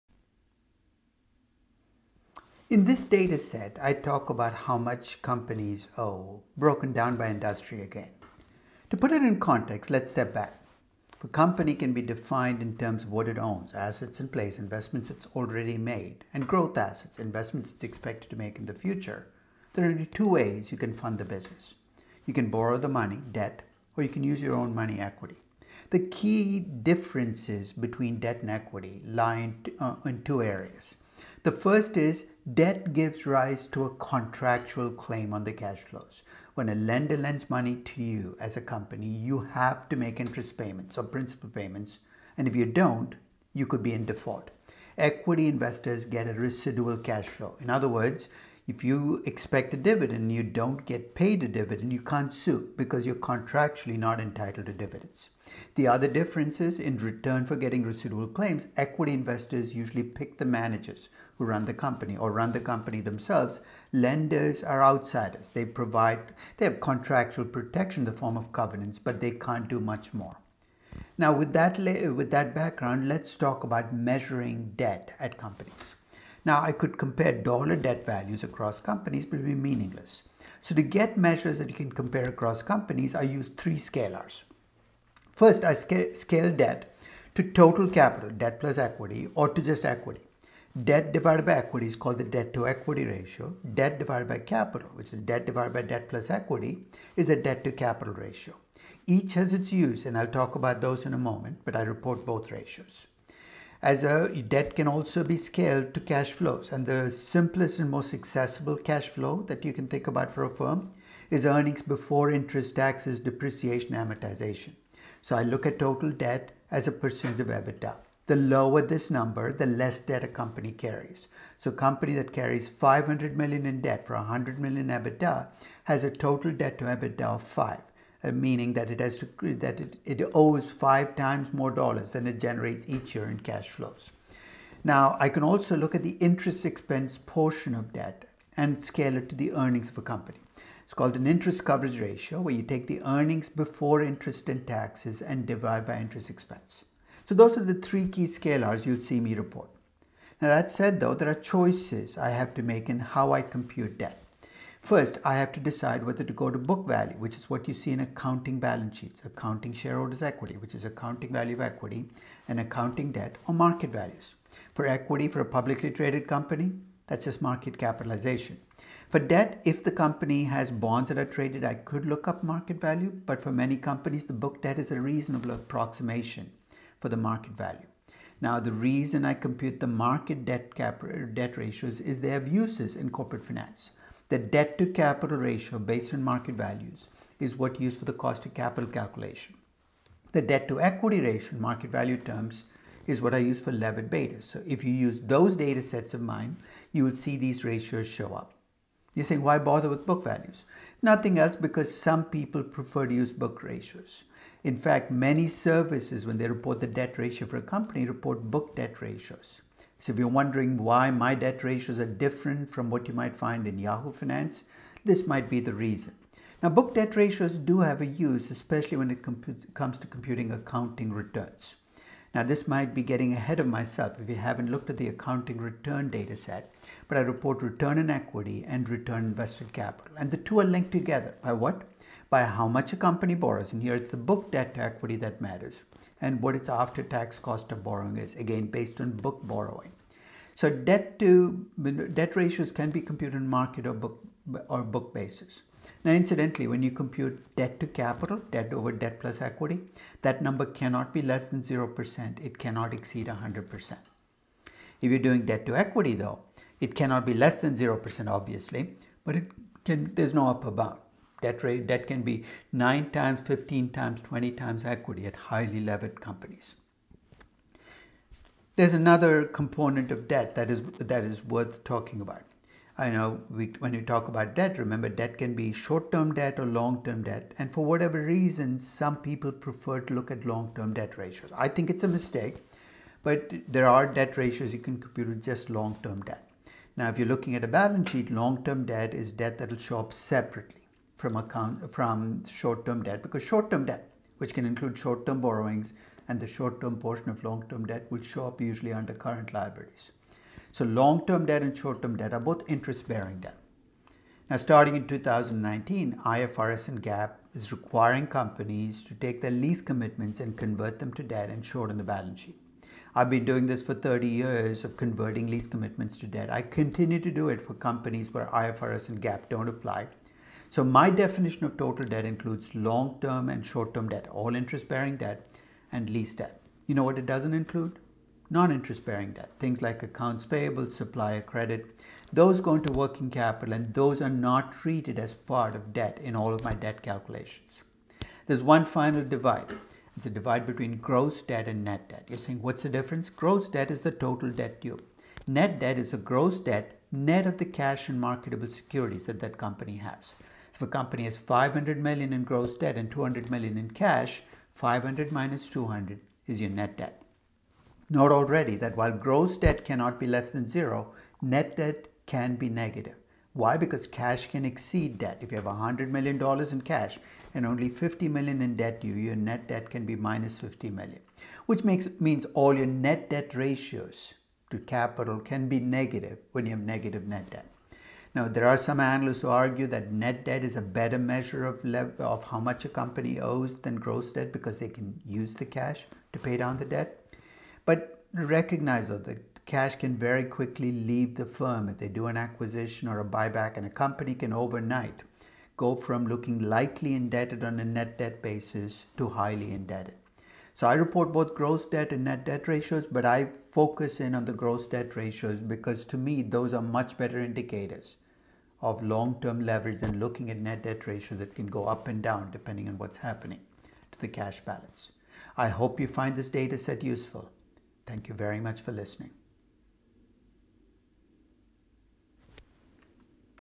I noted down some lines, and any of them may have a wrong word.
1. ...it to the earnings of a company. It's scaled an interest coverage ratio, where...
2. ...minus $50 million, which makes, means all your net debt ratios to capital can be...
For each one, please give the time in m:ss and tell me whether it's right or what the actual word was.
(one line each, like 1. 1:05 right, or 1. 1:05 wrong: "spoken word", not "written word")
1. 2:19 wrong: "called", not "scaled"
2. 6:10 right.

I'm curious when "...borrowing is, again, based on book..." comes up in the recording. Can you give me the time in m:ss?
3:57.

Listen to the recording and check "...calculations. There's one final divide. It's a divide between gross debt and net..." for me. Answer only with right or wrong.
right.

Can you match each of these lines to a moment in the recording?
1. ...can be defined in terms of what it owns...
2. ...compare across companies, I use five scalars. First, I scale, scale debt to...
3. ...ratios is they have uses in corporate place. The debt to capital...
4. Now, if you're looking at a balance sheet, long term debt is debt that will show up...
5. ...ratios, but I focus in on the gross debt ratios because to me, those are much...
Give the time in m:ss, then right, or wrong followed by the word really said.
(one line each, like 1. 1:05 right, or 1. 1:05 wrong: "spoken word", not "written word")
1. 0:11 right
2. 1:21 wrong: "three", not "five"
3. 3:01 wrong: "finance", not "place"
4. 4:46 right
5. 6:42 right.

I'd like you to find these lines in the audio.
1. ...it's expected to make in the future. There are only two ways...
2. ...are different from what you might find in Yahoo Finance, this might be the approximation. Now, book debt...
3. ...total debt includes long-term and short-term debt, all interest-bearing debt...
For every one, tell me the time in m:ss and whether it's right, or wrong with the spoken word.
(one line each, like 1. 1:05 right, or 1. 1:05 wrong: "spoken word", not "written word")
1. 0:17 right
2. 3:31 wrong: "reason", not "approximation"
3. 5:21 right.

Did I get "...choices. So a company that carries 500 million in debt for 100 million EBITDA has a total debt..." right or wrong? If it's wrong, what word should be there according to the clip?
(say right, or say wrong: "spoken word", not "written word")
wrong: "carries", not "choices".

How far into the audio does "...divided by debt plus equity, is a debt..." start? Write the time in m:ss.
1:35.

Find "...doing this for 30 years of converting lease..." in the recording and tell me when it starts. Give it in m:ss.
5:13.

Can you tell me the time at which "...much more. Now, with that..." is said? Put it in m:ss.
1:09.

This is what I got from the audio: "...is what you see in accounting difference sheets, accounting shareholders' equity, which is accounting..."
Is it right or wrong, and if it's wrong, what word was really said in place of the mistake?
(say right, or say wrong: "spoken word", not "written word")
wrong: "balance", not "difference".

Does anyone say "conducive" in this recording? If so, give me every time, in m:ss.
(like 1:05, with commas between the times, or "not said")
not said.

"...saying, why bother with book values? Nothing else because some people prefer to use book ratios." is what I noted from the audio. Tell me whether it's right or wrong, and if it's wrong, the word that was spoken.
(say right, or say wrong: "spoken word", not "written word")
right.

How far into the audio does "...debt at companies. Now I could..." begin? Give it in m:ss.
1:14.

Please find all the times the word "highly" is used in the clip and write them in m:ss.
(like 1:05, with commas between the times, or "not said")
4:25, 6:39.